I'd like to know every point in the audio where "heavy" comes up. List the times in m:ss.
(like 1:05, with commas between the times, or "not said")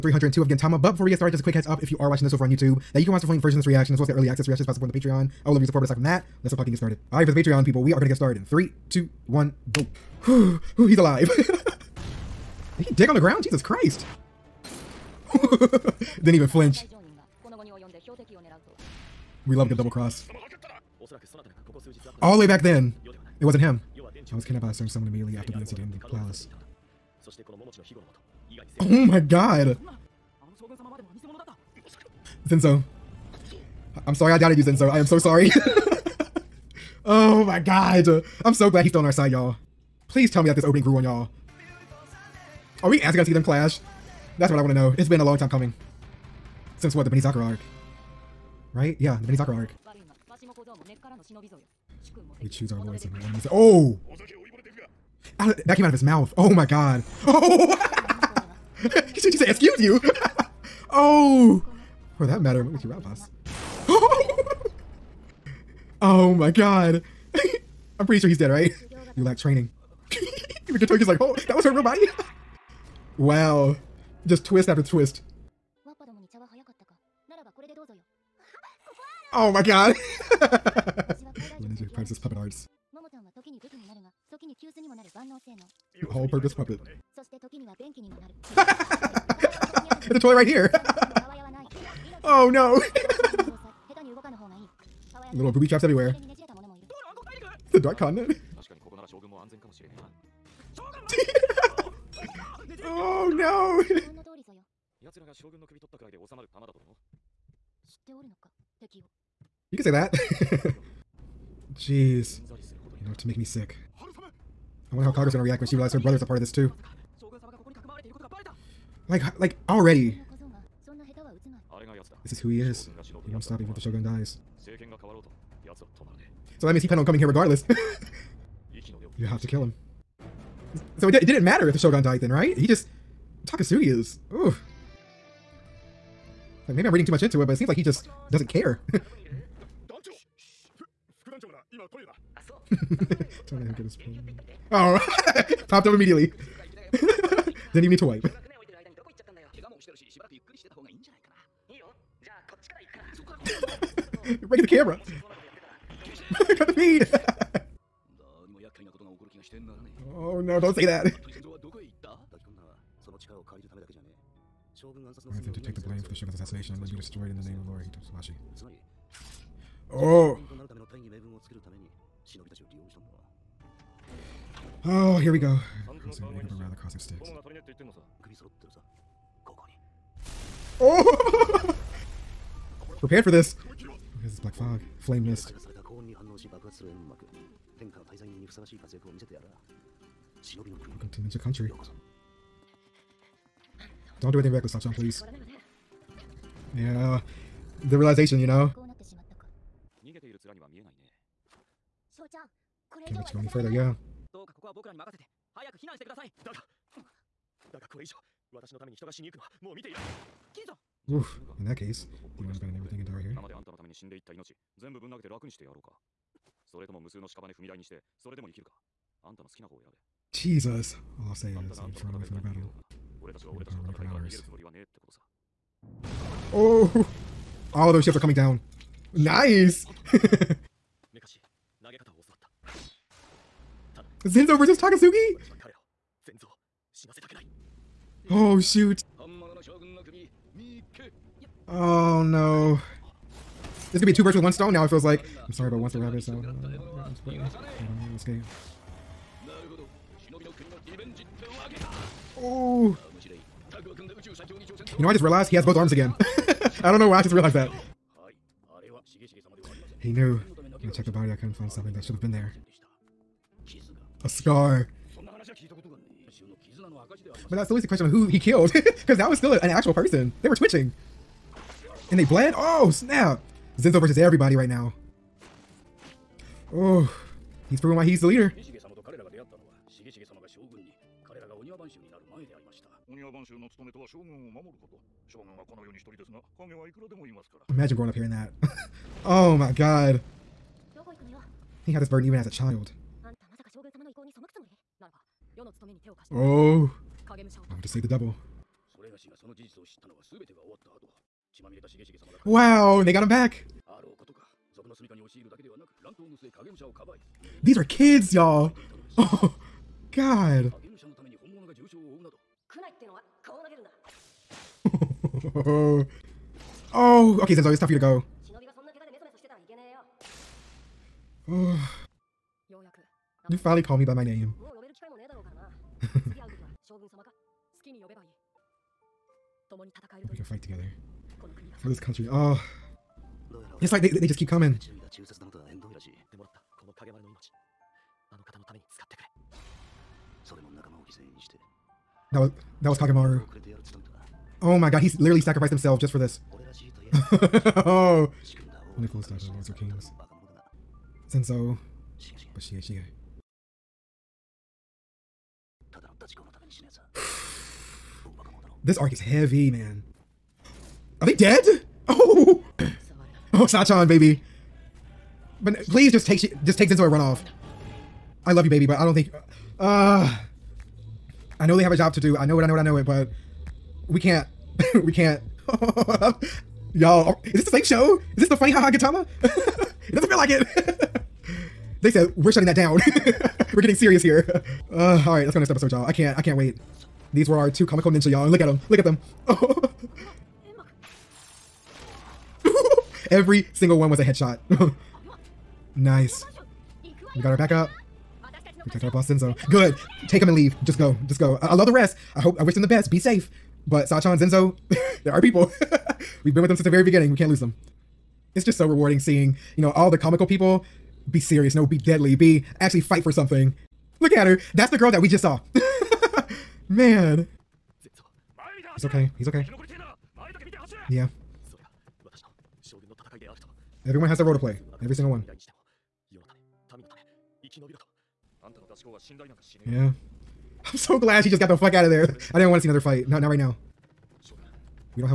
5:59.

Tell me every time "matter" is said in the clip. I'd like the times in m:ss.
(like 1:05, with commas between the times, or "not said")
1:02, 2:11.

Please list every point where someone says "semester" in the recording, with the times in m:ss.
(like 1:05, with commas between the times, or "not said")
not said.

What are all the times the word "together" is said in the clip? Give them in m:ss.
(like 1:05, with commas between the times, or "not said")
5:30.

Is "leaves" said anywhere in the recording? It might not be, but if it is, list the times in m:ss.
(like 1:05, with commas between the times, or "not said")
4:27, 6:40.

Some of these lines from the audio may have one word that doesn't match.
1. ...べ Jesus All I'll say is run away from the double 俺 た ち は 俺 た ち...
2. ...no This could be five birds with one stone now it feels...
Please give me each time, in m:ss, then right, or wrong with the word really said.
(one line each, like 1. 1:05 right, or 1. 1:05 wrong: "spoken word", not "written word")
1. 3:39 wrong: "battle", not "double"
2. 4:02 wrong: "two", not "five".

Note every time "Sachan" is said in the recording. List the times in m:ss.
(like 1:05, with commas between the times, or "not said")
3:14, 6:03, 6:44.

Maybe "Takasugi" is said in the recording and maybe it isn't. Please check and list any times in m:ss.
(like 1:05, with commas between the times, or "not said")
2:13, 3:54.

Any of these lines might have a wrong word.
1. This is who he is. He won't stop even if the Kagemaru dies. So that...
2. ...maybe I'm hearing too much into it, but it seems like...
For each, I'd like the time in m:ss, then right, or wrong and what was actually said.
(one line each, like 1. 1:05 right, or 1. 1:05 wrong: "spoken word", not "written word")
1. 2:02 wrong: "Shogun", not "Kagemaru"
2. 2:16 wrong: "reading", not "hearing".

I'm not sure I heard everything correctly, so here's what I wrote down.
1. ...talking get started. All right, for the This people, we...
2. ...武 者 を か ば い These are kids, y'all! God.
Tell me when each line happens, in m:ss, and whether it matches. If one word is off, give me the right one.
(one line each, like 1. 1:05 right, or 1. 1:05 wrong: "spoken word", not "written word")
1. 0:06 wrong: "Patreon", not "This"
2. 5:06 right.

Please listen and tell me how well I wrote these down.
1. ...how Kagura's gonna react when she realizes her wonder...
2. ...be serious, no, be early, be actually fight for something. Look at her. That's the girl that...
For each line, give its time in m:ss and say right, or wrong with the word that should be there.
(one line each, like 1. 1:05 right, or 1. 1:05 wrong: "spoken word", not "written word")
1. 1:55 wrong: "brother", not "wonder"
2. 6:51 wrong: "deadly", not "early".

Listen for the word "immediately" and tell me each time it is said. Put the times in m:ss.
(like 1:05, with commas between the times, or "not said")
0:25, 2:25.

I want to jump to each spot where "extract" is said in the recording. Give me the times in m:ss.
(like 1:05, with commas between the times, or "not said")
not said.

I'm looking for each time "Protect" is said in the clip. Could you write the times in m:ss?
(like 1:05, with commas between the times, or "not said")
6:38.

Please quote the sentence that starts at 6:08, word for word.
I love you, baby, but I don't think.